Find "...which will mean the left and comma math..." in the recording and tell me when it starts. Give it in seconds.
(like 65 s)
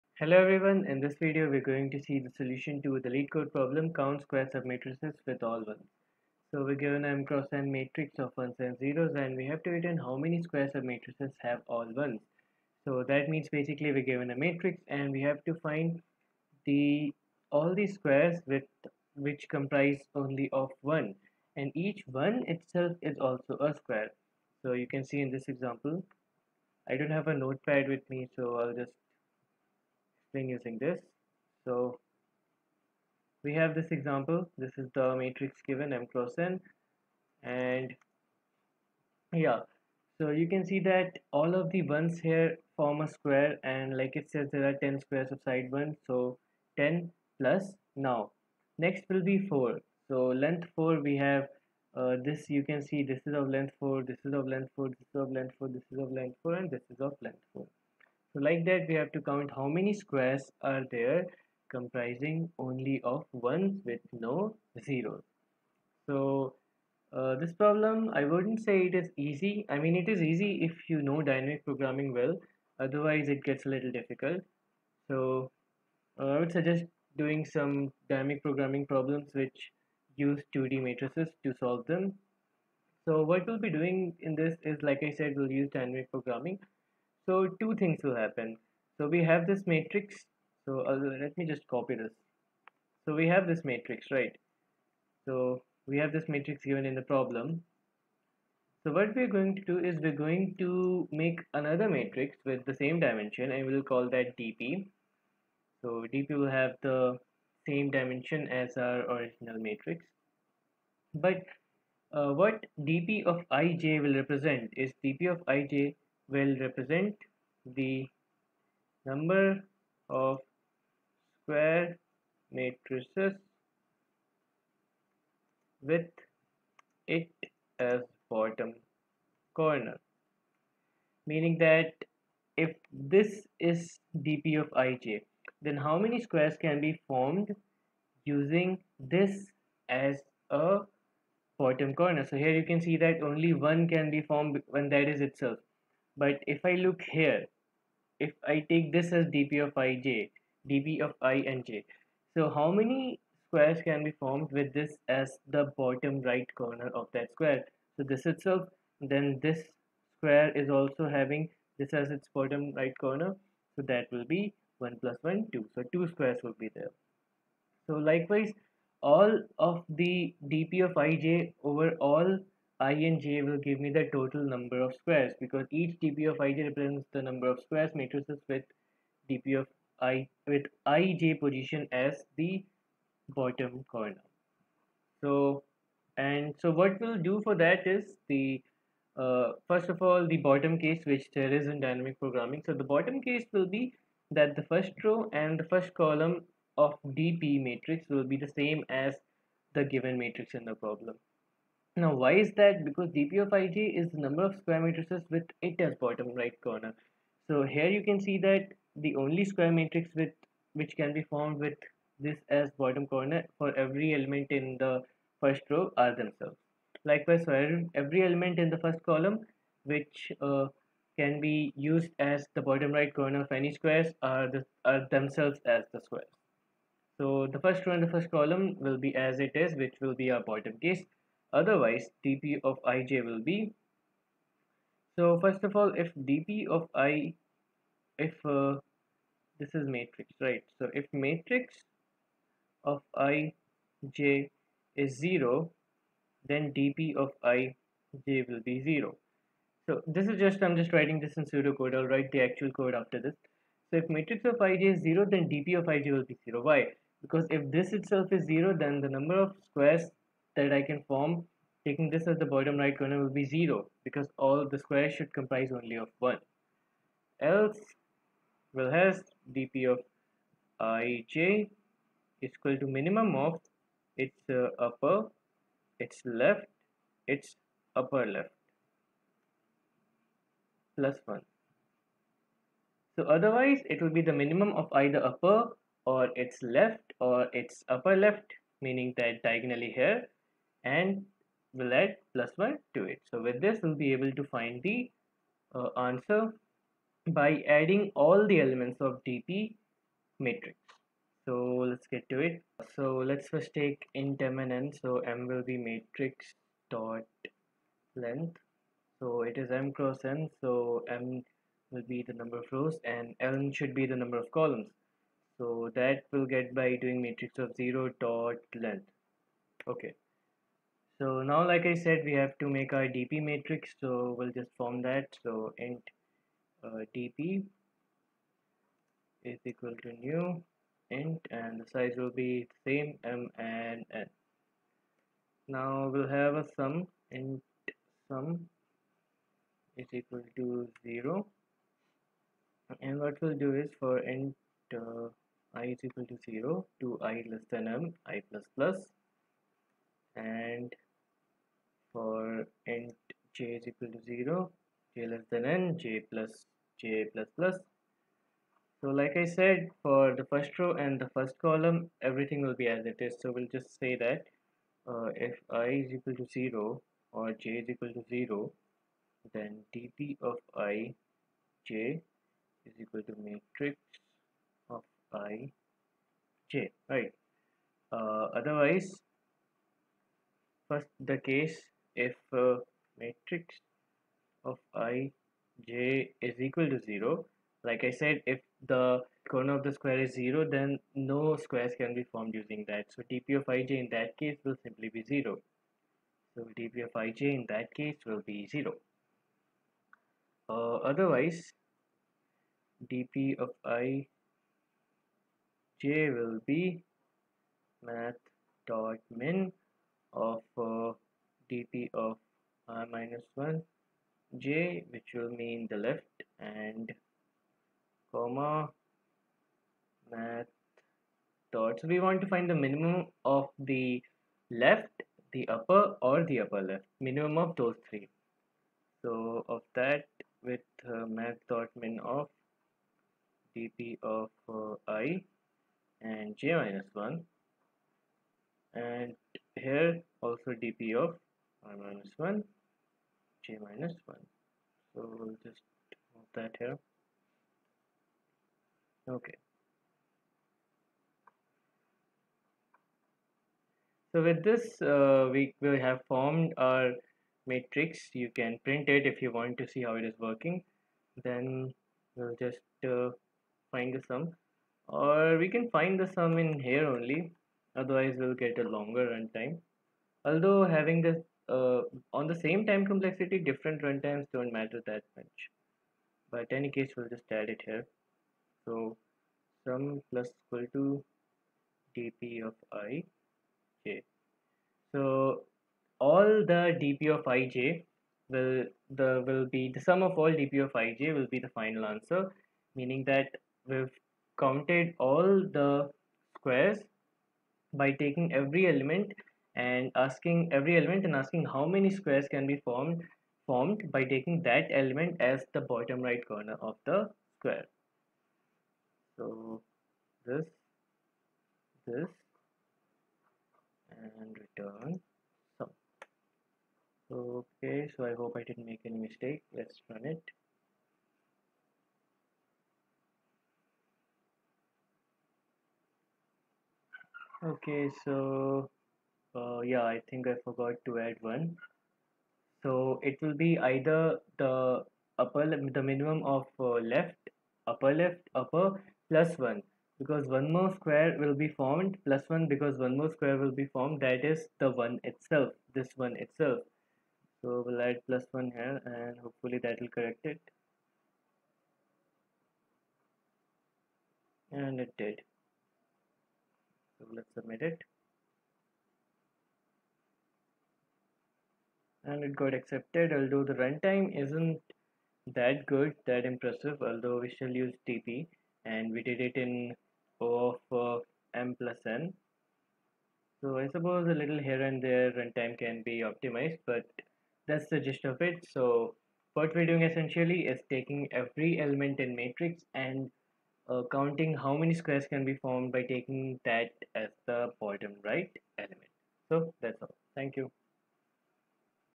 415 s.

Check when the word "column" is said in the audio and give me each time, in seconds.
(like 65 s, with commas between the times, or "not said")
196 s, 219 s, 228 s, 314 s, 361 s.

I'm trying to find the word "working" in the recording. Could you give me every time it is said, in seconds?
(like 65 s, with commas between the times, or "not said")
460 s.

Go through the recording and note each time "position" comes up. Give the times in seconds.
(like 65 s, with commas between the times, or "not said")
181 s.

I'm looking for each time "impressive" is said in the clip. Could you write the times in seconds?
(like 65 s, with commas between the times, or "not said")
566 s.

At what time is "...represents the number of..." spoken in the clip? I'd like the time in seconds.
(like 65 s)
176 s.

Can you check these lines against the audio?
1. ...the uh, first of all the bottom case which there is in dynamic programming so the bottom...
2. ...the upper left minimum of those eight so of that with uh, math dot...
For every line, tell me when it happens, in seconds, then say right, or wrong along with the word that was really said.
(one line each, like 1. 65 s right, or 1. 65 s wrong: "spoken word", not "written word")
1. 188 s right
2. 426 s wrong: "three", not "eight".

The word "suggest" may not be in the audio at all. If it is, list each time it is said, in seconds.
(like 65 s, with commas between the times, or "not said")
76 s.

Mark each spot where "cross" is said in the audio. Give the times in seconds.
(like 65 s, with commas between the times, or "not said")
7 s, 36 s, 309 s.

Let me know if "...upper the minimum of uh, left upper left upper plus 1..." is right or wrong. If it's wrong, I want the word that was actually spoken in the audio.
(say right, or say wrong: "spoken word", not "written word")
right.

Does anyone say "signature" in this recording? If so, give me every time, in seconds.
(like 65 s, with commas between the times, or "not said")
not said.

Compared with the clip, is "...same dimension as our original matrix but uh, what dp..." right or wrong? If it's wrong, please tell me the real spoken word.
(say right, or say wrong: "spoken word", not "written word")
right.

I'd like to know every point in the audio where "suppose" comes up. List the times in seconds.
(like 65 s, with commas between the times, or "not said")
573 s.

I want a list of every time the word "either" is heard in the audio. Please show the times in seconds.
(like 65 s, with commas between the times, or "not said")
284 s, 533 s.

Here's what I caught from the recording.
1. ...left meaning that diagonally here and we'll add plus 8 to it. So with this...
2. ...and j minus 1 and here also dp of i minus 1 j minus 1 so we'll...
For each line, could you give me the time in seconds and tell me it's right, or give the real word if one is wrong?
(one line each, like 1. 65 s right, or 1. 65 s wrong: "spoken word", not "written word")
1. 288 s wrong: "1", not "8"
2. 436 s right.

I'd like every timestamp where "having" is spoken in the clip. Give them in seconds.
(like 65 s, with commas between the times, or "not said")
161 s, 470 s.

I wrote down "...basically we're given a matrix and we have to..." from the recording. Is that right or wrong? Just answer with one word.
right.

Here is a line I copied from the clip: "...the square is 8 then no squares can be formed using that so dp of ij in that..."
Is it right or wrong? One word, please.
wrong.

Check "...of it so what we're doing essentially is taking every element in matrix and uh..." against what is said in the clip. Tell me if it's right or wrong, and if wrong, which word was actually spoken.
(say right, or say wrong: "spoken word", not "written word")
right.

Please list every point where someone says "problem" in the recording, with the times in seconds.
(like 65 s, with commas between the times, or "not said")
3 s, 67 s, 78 s, 97 s, 200 s.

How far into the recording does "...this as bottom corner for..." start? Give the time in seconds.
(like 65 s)
212 s.